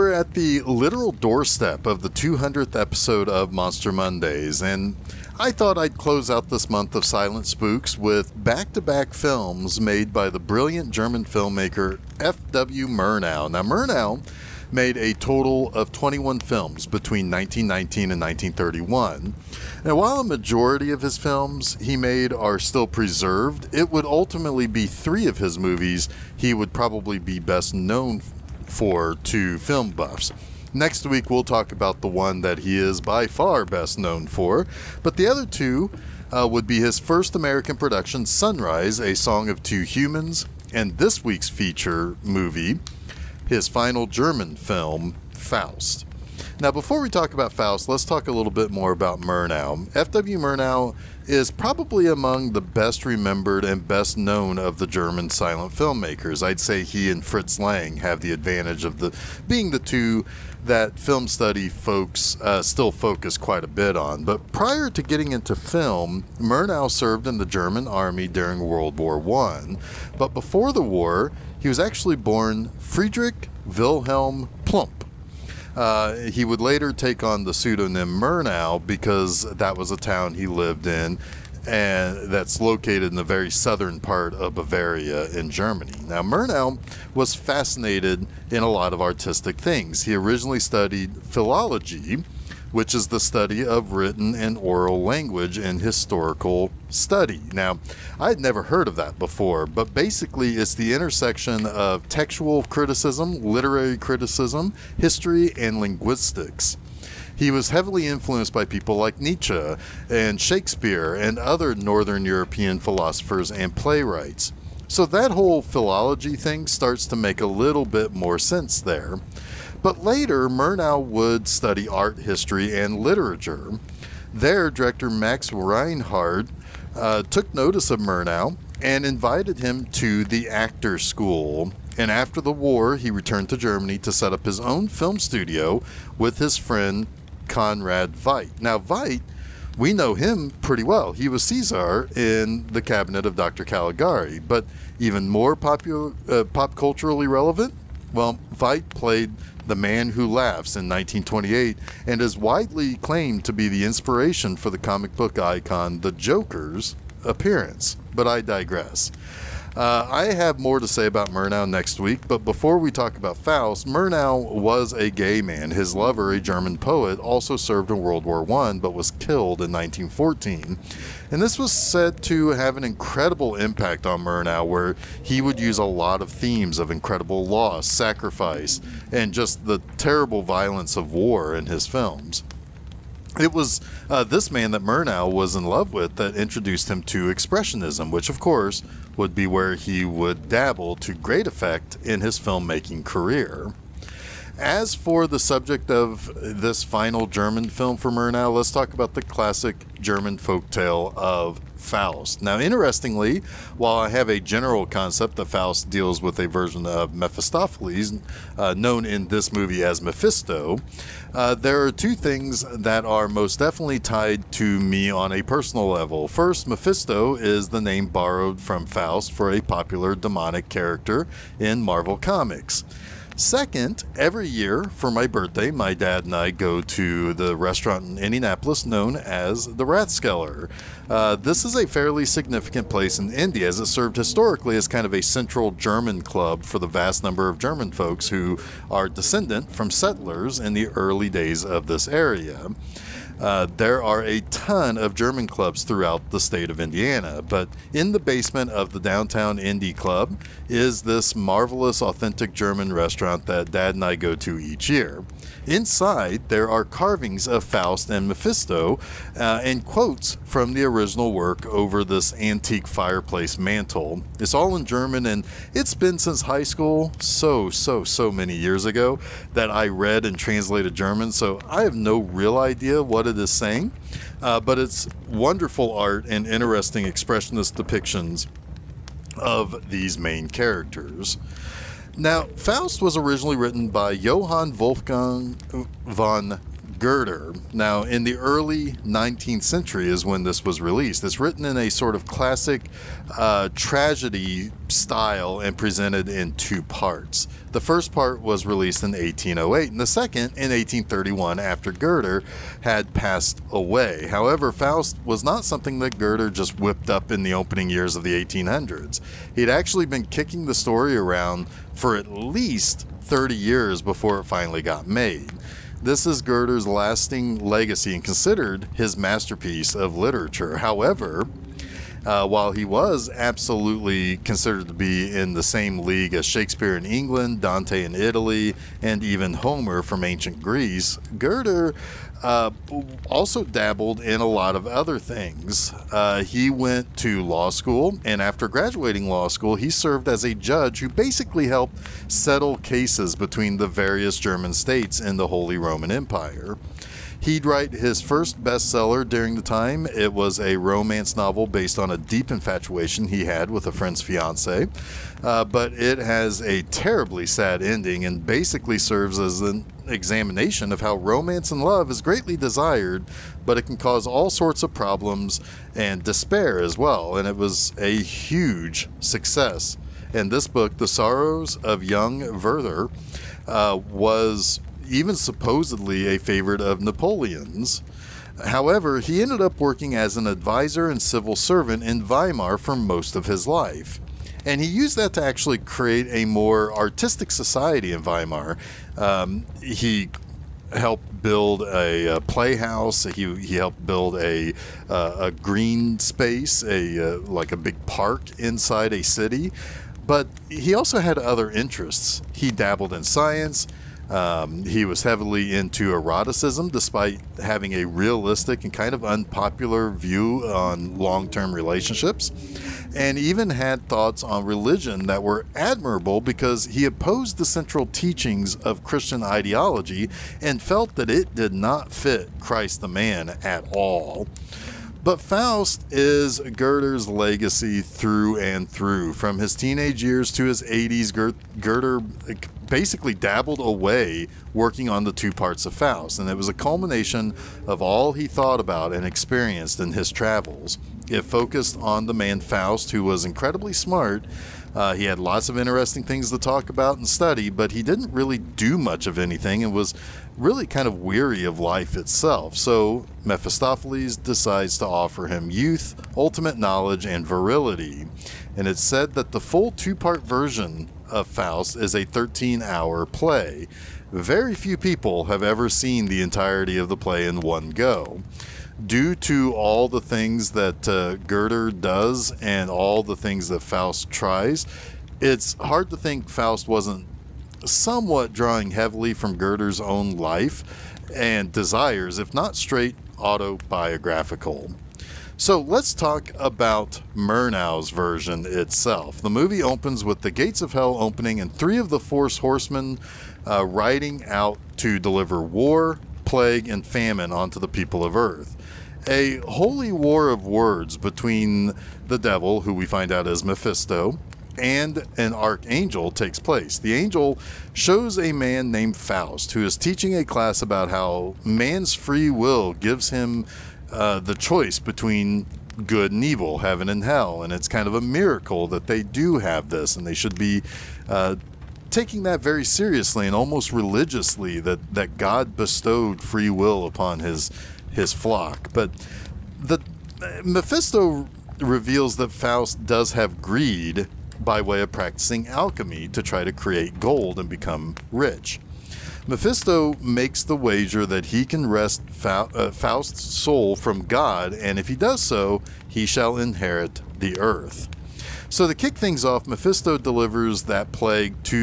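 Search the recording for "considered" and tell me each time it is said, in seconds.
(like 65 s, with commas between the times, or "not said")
318 s, 324 s.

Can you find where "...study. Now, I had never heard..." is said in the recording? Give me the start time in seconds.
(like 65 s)
96 s.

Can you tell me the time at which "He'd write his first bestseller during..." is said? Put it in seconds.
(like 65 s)
347 s.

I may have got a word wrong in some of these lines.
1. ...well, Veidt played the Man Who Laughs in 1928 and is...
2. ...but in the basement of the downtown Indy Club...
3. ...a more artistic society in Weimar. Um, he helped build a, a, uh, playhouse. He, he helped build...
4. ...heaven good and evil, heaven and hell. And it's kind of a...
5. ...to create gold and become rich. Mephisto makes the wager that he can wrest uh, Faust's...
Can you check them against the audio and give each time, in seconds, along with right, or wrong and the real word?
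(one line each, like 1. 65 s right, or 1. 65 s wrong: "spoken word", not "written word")
1. 148 s right
2. 247 s right
3. 386 s right
4. 514 s wrong: "between", not "heaven"
5. 536 s right.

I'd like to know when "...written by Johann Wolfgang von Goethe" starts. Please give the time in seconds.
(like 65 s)
283 s.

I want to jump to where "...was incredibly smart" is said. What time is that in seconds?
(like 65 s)
443 s.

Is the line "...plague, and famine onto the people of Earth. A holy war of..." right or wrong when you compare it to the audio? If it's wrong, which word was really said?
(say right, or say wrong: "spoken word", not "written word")
right.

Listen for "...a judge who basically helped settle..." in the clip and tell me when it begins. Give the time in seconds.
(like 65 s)
340 s.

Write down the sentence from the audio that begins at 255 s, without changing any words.
Inside, there are carvings of Faust and Mephisto uh, and quotes from the original work over this antique fireplace mantle.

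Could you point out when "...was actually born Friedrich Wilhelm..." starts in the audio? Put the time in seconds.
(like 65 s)
71 s.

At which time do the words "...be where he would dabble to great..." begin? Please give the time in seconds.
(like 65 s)
189 s.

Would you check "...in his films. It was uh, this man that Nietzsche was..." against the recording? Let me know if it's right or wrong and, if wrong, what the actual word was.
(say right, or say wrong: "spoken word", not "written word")
wrong: "Murnau", not "Nietzsche".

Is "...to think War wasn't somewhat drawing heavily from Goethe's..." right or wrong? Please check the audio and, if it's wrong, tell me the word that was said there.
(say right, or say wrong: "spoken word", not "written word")
wrong: "Faust", not "War".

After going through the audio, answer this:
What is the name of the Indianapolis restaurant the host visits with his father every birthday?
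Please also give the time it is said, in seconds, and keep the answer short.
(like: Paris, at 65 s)
Rathskeller, at 229 s.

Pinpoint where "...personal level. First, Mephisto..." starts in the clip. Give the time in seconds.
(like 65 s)
215 s.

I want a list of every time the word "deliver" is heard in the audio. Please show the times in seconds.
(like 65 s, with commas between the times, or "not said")
495 s, 550 s.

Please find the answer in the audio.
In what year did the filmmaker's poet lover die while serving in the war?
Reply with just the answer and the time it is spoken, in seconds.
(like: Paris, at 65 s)
1914, at 169 s.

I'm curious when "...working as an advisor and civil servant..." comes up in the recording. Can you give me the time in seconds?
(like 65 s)
379 s.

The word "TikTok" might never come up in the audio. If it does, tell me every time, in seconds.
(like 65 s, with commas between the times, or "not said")
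not said.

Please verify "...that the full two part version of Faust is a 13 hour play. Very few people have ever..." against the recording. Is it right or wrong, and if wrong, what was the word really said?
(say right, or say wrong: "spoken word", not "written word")
right.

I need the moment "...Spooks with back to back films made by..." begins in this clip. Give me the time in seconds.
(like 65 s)
7 s.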